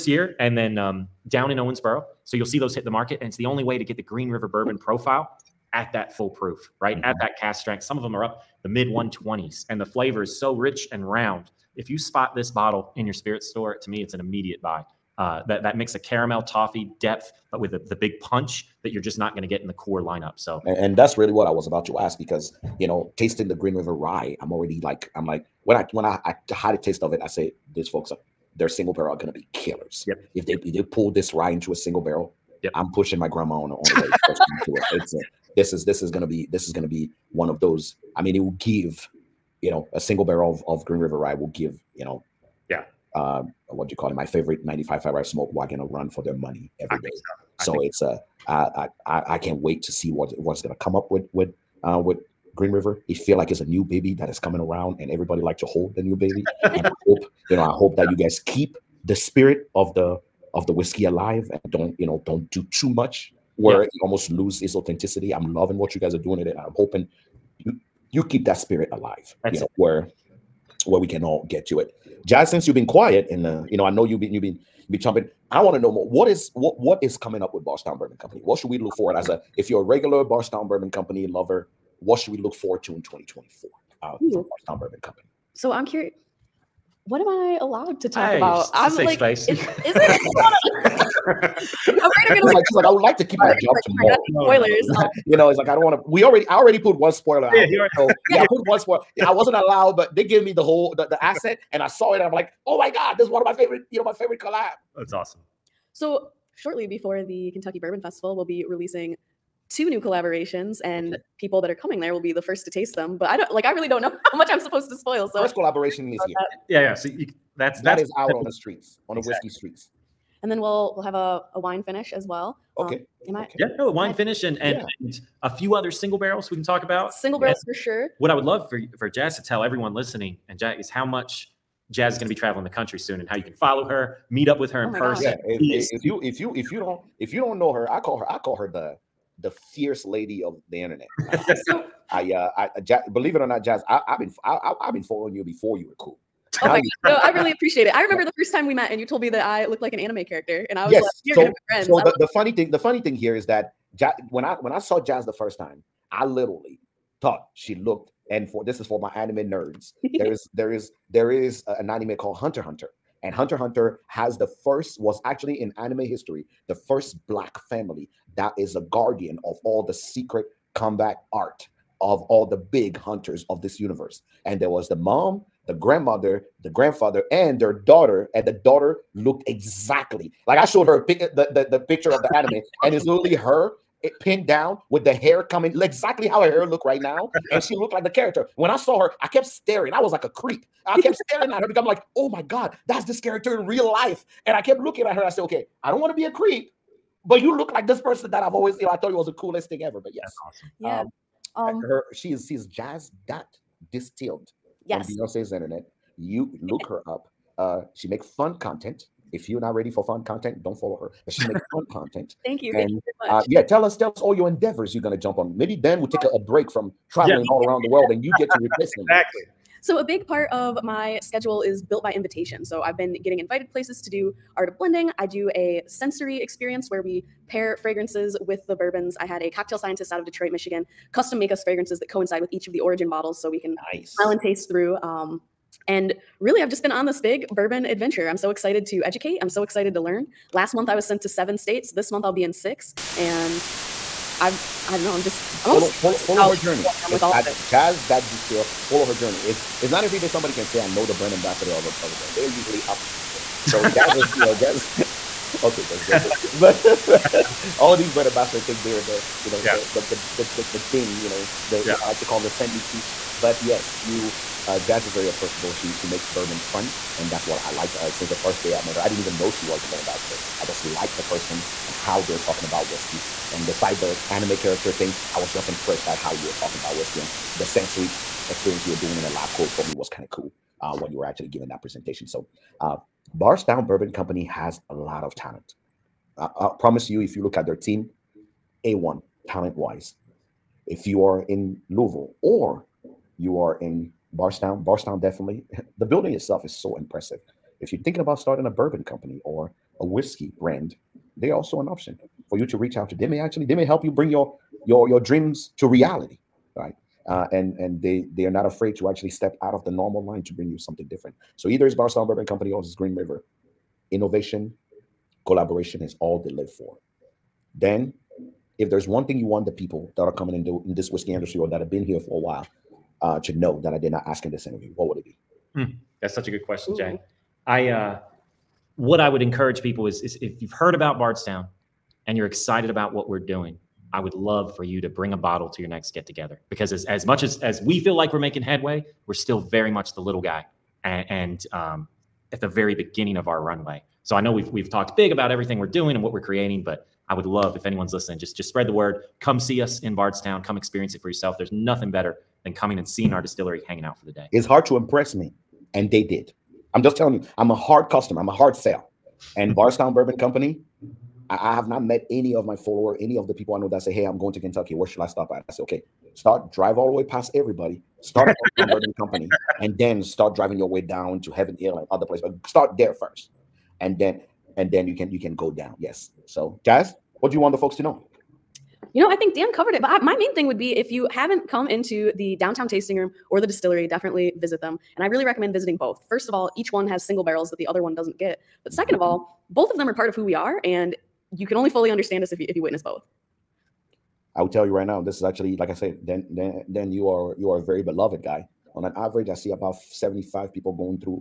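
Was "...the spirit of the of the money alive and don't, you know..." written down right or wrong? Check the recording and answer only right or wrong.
wrong.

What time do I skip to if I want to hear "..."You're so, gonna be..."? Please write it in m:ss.
2:31.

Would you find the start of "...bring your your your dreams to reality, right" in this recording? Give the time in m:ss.
5:04.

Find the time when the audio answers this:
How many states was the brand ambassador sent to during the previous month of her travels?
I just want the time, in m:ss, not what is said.
4:01.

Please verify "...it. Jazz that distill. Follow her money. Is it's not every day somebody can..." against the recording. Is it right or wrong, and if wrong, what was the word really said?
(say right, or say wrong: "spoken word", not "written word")
wrong: "journey", not "money".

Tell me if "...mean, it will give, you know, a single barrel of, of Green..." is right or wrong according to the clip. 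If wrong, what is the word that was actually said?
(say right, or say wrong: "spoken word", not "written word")
right.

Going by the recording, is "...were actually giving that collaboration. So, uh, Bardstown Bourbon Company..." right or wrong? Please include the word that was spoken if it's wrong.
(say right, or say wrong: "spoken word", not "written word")
wrong: "presentation", not "collaboration".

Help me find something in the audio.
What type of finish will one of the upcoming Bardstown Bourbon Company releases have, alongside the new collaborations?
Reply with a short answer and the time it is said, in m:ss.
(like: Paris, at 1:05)
Wine finish, at 2:01.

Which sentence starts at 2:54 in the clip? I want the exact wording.
And there was the mom, the grandmother, the grandfather, and their daughter.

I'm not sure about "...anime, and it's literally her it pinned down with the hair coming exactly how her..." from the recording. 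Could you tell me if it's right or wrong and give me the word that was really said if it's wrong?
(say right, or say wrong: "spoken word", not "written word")
right.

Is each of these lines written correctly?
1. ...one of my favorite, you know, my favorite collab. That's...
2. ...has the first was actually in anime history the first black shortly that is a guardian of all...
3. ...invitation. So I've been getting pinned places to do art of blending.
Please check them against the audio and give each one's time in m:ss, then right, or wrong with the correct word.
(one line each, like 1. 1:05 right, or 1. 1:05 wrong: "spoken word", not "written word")
1. 1:43 right
2. 2:44 wrong: "family", not "shortly"
3. 3:42 wrong: "invited", not "pinned".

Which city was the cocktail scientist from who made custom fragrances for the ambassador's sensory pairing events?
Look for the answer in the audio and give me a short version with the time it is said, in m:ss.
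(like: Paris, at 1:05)
Detroit, Michigan, at 3:50.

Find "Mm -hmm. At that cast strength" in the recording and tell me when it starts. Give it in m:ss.
0:06.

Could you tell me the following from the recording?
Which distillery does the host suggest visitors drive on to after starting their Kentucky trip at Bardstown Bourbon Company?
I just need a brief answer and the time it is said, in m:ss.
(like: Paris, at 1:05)
Heaven Hill, at 6:11.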